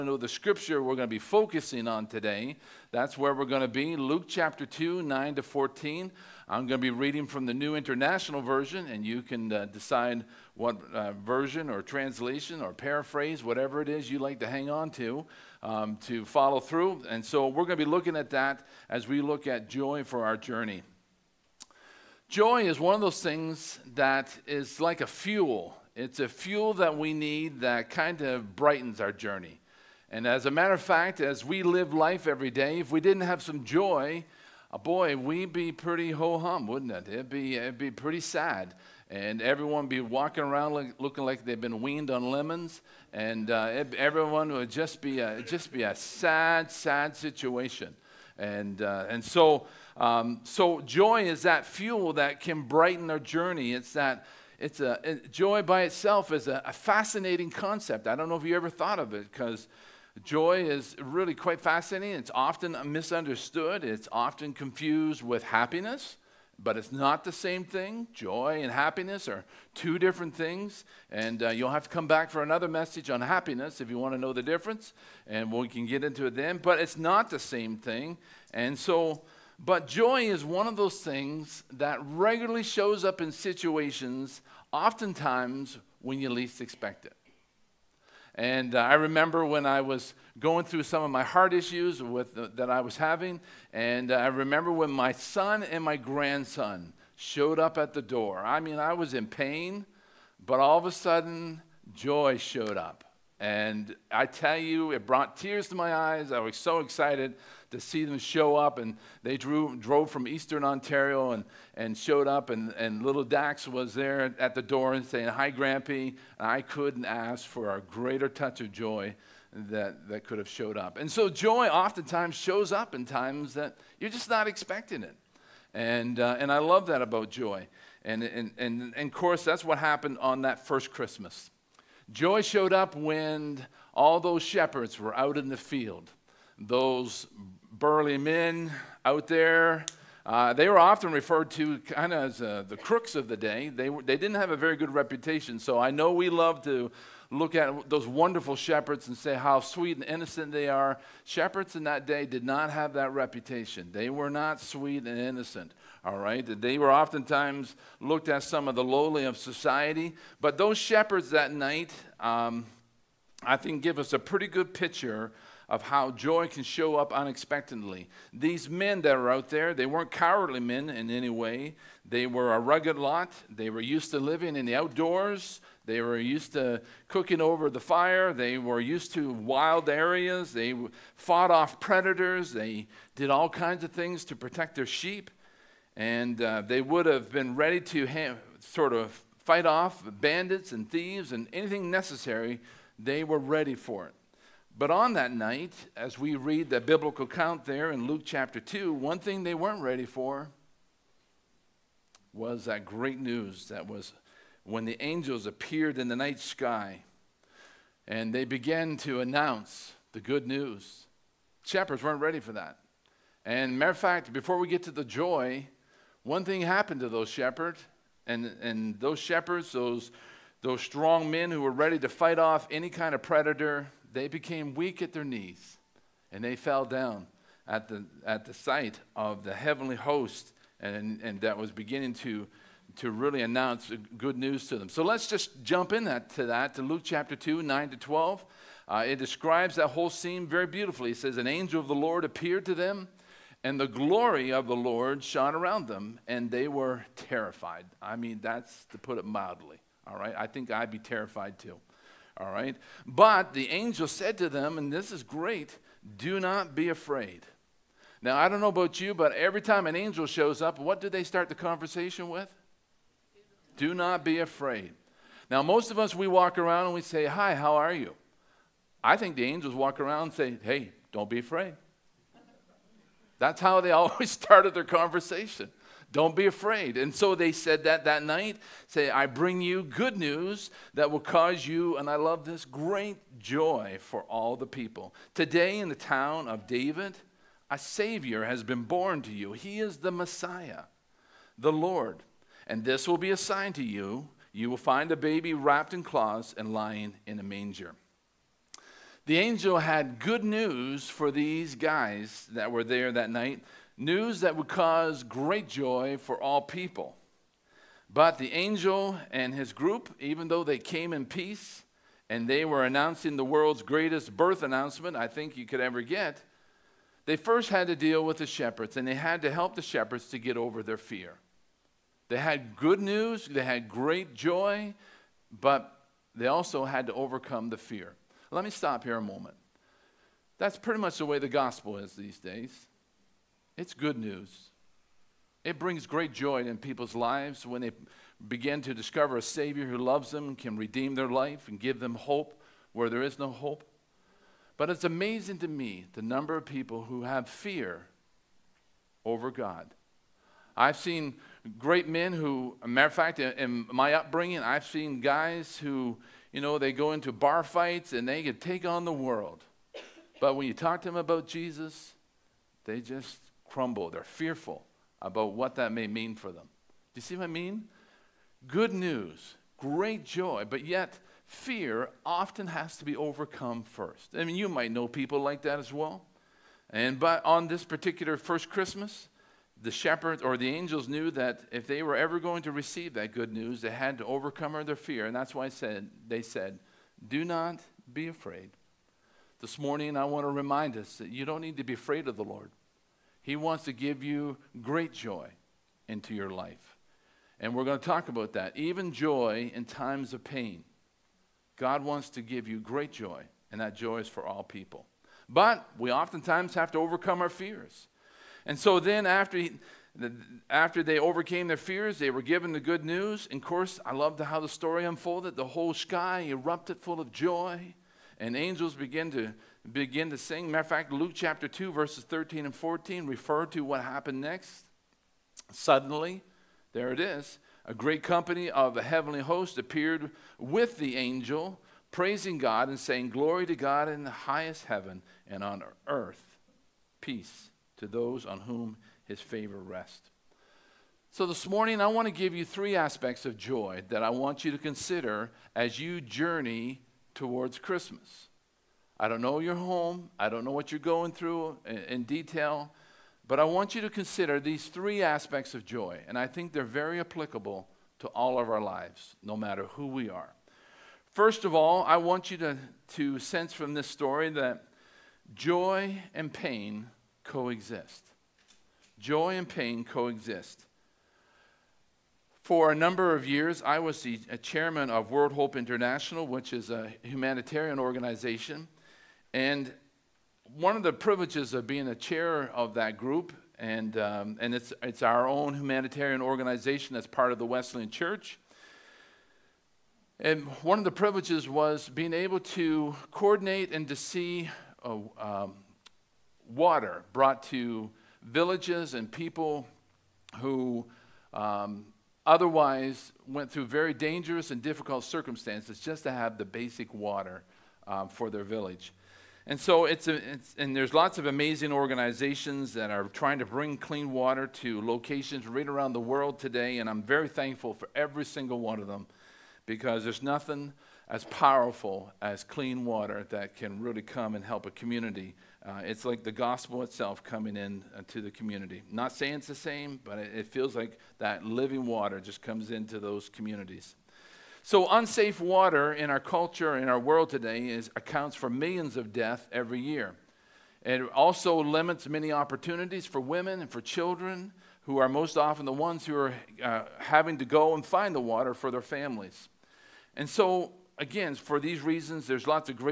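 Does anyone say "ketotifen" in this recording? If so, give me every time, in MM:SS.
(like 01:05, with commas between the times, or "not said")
not said.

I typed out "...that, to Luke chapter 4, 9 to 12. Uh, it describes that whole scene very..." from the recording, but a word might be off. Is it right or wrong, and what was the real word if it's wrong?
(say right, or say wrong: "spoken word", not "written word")
wrong: "2", not "4".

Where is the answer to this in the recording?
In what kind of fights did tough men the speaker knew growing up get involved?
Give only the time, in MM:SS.
05:57.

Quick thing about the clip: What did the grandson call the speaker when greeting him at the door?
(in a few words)
Grampy.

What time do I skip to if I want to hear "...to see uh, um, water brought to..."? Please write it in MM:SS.
08:14.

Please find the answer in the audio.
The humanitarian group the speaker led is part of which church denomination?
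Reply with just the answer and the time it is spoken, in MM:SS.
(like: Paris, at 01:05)
Wesleyan Church, at 08:07.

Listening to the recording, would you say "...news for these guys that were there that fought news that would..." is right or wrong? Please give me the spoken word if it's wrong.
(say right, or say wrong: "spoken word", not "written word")
wrong: "night", not "fought".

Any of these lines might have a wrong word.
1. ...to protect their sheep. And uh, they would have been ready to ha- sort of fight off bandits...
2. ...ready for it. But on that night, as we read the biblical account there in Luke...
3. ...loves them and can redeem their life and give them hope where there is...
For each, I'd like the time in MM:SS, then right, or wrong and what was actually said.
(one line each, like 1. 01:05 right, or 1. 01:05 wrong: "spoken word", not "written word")
1. 03:04 right
2. 03:13 right
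3. 05:39 right.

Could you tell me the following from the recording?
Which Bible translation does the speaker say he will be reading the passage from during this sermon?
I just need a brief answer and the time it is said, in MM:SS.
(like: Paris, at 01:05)
New International Version, at 00:07.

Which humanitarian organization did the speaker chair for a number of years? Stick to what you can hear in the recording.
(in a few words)
World Hope International.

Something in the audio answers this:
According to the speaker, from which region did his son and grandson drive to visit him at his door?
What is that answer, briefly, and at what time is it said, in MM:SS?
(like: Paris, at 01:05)
Eastern Ontario, at 01:50.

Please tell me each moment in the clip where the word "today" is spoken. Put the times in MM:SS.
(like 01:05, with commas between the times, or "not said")
00:02, 04:45, 08:36, 08:57.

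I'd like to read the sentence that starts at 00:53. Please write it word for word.
It's that it's a, it, joy by itself is a, a fascinating concept.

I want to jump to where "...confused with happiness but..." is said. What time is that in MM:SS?
01:04.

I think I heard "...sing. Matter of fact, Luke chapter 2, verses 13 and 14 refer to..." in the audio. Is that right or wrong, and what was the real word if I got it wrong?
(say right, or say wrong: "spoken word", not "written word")
right.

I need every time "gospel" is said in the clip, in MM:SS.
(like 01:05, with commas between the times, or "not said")
05:31, 08:46.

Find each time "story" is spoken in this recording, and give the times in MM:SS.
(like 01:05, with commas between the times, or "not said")
06:54, 07:44.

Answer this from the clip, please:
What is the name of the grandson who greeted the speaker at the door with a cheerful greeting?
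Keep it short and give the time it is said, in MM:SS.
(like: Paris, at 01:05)
Dax, at 01:53.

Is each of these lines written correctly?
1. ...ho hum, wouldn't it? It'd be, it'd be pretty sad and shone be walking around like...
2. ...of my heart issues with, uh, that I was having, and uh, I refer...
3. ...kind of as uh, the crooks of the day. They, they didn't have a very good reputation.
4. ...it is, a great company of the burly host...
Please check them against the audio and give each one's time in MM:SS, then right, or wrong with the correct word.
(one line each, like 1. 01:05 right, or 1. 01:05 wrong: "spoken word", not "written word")
1. 00:36 wrong: "everyone", not "shone"
2. 01:31 wrong: "remember", not "refer"
3. 02:21 right
4. 07:07 wrong: "heavenly", not "burly".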